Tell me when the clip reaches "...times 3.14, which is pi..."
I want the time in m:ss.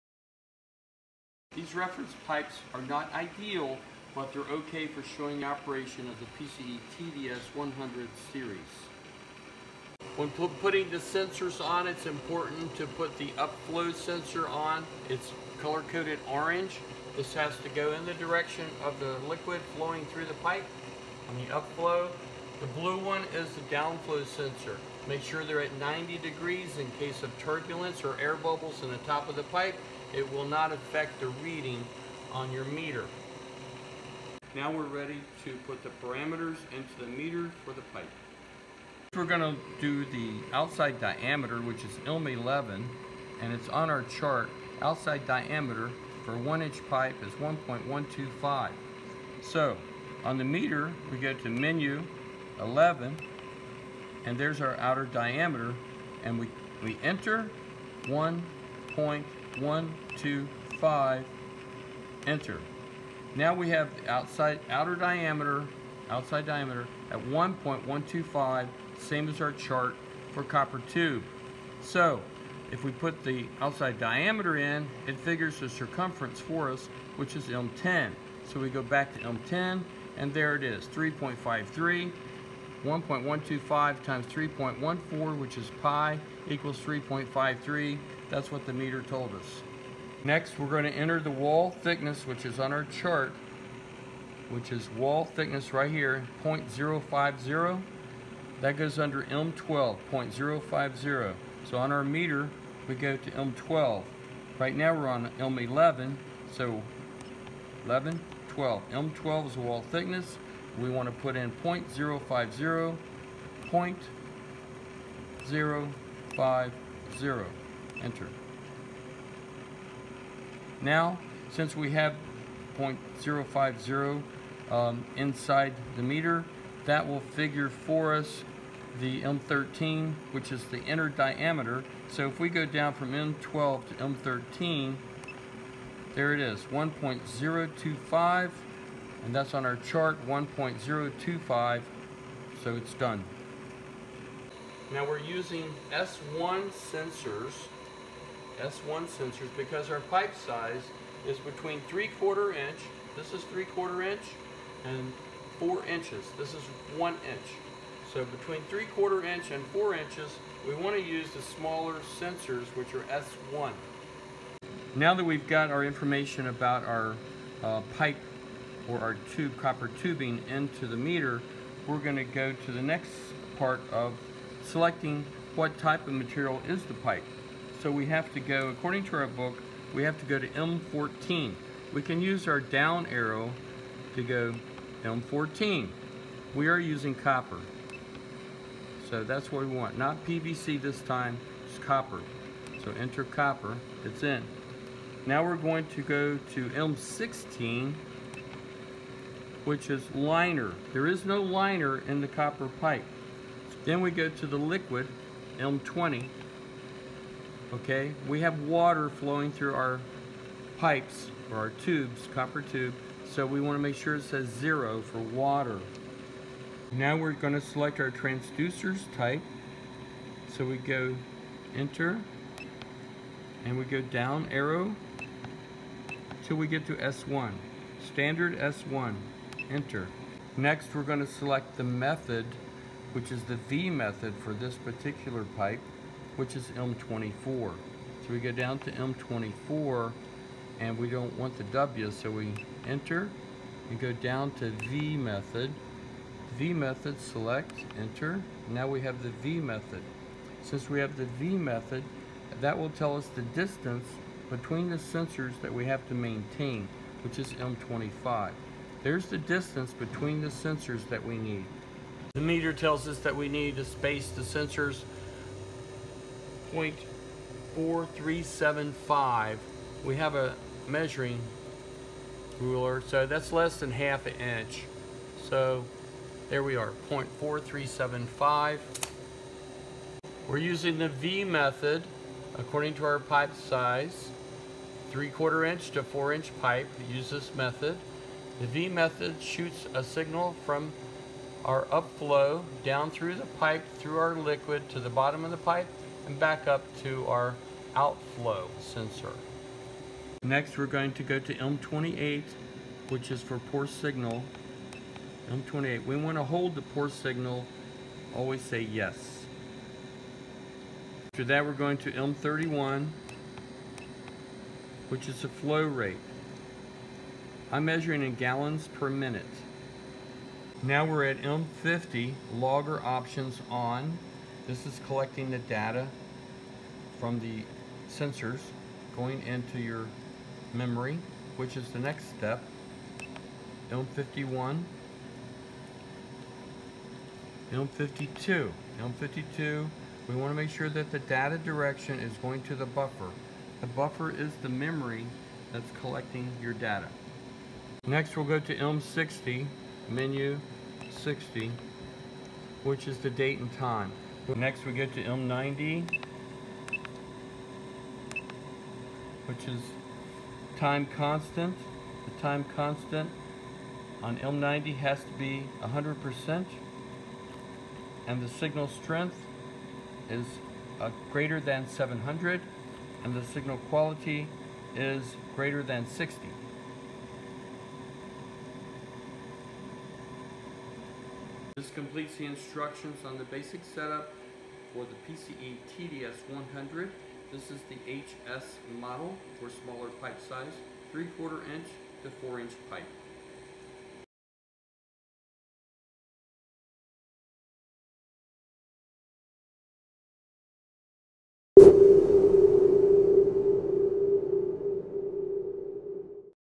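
1:24.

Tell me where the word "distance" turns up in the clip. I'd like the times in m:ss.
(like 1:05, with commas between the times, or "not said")
4:13, 4:19.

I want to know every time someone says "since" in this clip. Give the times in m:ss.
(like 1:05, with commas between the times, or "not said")
2:01, 4:10.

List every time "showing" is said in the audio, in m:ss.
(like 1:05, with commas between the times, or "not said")
0:05.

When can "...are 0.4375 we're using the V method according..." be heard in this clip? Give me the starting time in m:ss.
4:36.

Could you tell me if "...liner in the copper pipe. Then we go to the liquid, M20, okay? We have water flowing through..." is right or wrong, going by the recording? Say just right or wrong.
right.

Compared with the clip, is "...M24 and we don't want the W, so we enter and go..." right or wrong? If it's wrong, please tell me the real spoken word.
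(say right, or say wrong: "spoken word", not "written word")
right.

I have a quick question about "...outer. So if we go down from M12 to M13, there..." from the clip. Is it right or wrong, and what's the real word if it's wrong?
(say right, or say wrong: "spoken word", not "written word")
wrong: "diameter", not "outer".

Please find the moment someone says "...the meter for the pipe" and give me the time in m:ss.
0:36.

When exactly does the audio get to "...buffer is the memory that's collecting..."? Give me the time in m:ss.
5:43.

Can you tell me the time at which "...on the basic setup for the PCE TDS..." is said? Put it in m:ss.
6:23.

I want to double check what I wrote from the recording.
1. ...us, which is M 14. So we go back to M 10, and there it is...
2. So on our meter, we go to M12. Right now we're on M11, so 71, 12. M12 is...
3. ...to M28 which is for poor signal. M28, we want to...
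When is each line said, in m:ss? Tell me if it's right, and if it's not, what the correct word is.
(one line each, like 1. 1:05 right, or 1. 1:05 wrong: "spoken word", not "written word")
1. 1:16 wrong: "10", not "14"
2. 1:41 wrong: "11", not "71"
3. 5:01 right.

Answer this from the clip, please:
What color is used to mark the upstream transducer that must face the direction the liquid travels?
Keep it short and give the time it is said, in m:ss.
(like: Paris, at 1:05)
Orange, at 0:16.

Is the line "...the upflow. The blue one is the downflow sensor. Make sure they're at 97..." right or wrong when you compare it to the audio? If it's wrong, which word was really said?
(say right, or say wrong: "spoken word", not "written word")
wrong: "90", not "97".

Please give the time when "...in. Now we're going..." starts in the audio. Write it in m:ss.
3:14.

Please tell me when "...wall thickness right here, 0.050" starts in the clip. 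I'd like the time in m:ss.
1:34.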